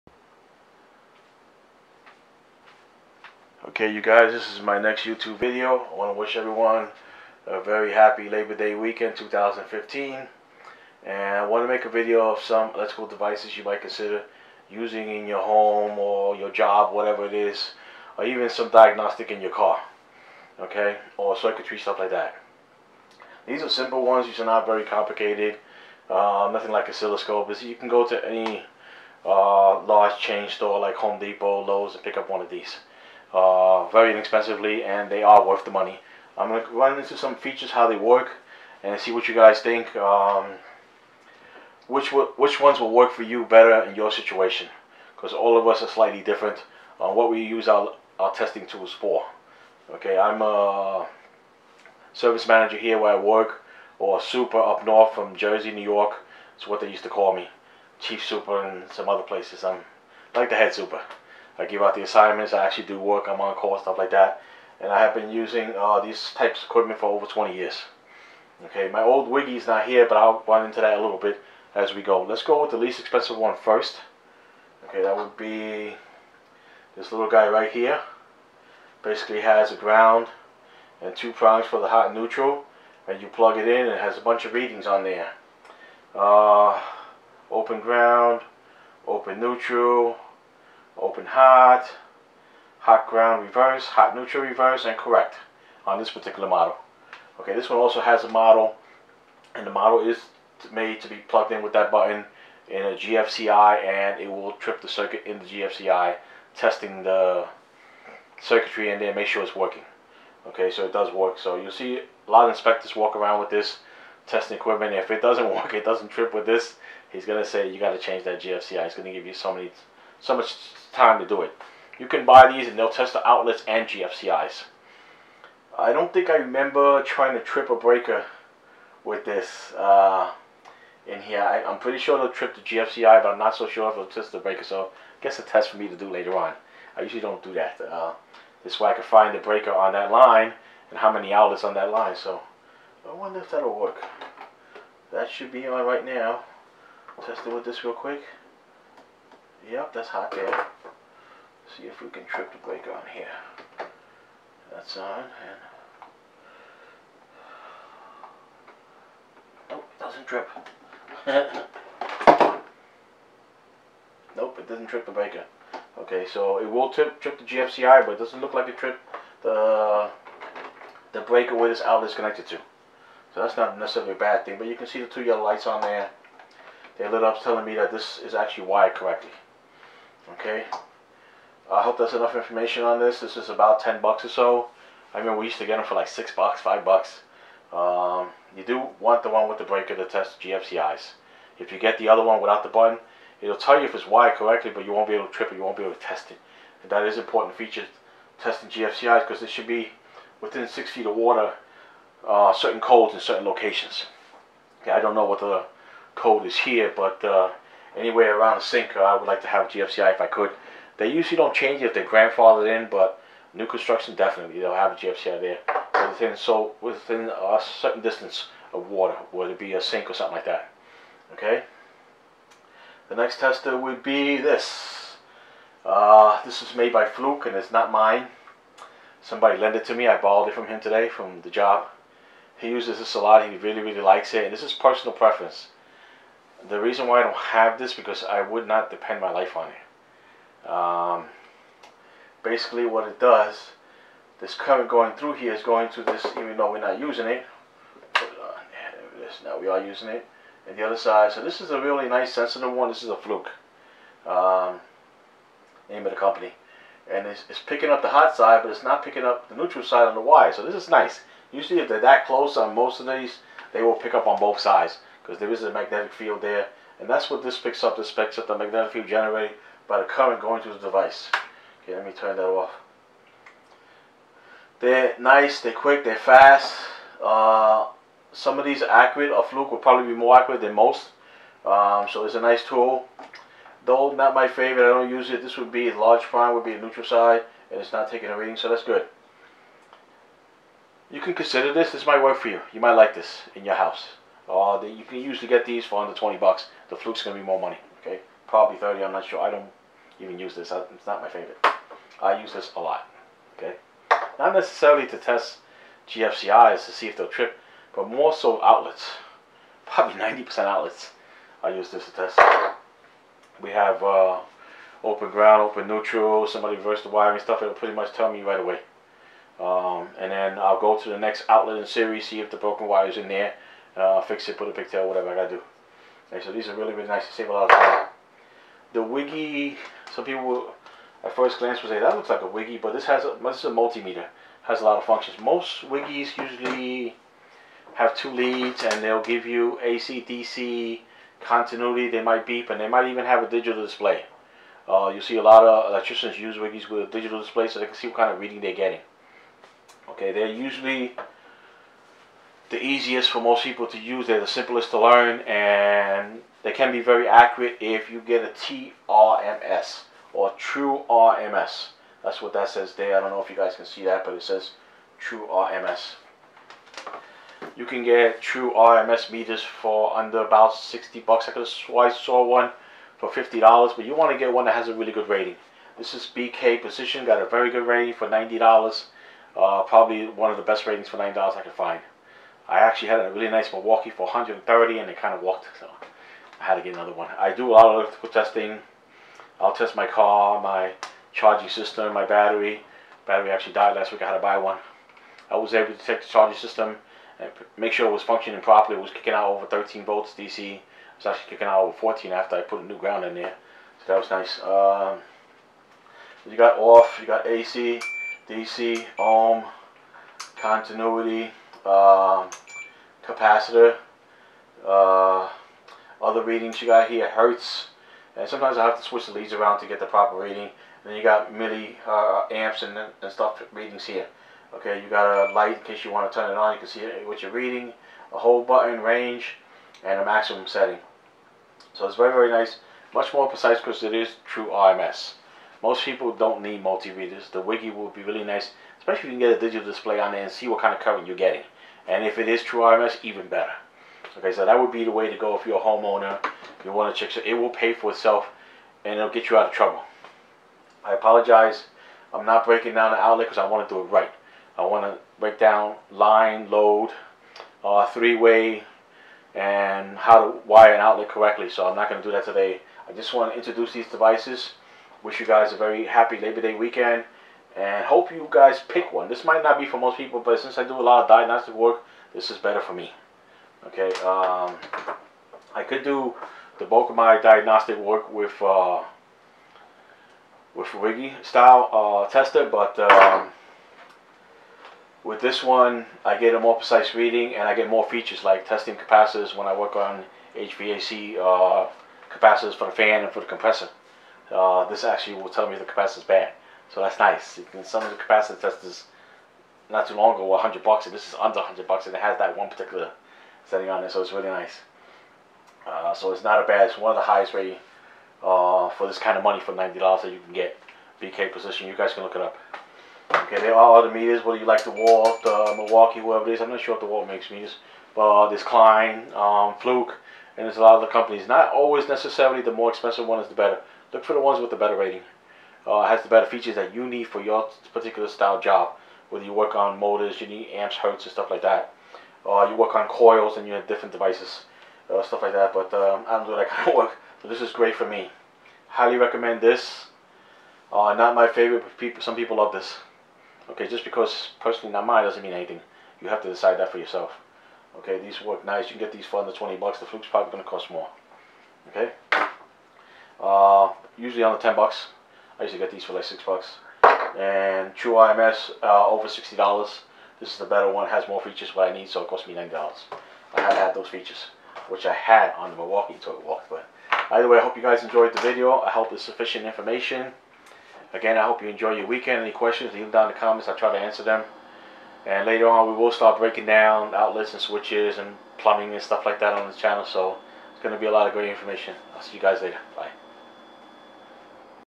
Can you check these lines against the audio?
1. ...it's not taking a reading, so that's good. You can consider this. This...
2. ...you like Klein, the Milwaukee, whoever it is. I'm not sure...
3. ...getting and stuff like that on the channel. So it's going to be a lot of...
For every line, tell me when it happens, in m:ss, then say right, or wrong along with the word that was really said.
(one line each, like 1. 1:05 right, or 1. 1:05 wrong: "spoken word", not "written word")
1. 4:47 right
2. 8:34 wrong: "DeWalt", not "Klein"
3. 9:38 wrong: "plumbing", not "getting".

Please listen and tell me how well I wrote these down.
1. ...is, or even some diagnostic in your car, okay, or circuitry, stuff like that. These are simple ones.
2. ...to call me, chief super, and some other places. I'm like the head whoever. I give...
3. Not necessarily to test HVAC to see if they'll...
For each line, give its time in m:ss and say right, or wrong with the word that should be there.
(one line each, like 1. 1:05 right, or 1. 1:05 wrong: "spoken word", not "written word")
1. 0:17 right
2. 0:57 wrong: "super", not "whoever"
3. 5:04 wrong: "GFCIs", not "HVAC".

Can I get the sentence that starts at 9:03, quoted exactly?
Okay, just because personally not mine doesn't mean anything.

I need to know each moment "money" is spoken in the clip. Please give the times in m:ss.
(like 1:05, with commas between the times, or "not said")
0:35, 4:57, 8:29.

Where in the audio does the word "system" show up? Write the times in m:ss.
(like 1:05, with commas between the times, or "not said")
6:31, 6:36.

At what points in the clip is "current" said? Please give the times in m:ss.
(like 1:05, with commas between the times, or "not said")
4:04, 4:30, 7:21.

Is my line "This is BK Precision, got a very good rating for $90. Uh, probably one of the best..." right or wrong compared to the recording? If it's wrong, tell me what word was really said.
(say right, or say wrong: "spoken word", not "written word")
right.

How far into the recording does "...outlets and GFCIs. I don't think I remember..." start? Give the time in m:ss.
2:03.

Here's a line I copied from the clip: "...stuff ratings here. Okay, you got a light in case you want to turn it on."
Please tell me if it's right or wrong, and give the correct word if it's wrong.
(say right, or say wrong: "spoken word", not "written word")
wrong: "readings", not "ratings".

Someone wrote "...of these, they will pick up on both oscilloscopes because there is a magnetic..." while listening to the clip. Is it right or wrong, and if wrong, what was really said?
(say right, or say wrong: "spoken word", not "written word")
wrong: "sides", not "oscilloscopes".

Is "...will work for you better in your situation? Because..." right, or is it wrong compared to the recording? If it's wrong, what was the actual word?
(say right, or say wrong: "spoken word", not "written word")
right.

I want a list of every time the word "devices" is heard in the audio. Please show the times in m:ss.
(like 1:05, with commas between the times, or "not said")
0:13, 4:30, 7:44, 8:54.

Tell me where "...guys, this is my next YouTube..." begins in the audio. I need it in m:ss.
0:04.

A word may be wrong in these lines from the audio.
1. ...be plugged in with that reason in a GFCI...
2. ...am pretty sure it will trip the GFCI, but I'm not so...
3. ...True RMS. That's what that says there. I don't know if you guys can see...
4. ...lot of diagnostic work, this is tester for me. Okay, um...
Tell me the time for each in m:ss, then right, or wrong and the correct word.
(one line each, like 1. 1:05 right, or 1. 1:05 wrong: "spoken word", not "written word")
1. 1:41 wrong: "button", not "reason"
2. 2:11 right
3. 6:00 right
4. 7:51 wrong: "better", not "tester".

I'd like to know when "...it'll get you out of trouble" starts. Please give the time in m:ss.
7:29.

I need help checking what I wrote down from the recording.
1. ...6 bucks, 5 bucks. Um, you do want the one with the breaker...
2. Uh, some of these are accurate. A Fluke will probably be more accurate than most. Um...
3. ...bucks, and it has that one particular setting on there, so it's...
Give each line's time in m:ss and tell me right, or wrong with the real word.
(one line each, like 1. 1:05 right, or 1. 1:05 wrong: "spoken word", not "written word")
1. 3:06 right
2. 4:37 right
3. 8:21 right.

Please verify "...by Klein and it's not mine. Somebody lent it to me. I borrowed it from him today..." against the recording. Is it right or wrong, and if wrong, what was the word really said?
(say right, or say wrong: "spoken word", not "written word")
wrong: "Fluke", not "Klein".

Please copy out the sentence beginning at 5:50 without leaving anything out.
Okay, they're usually the easiest for most people to use.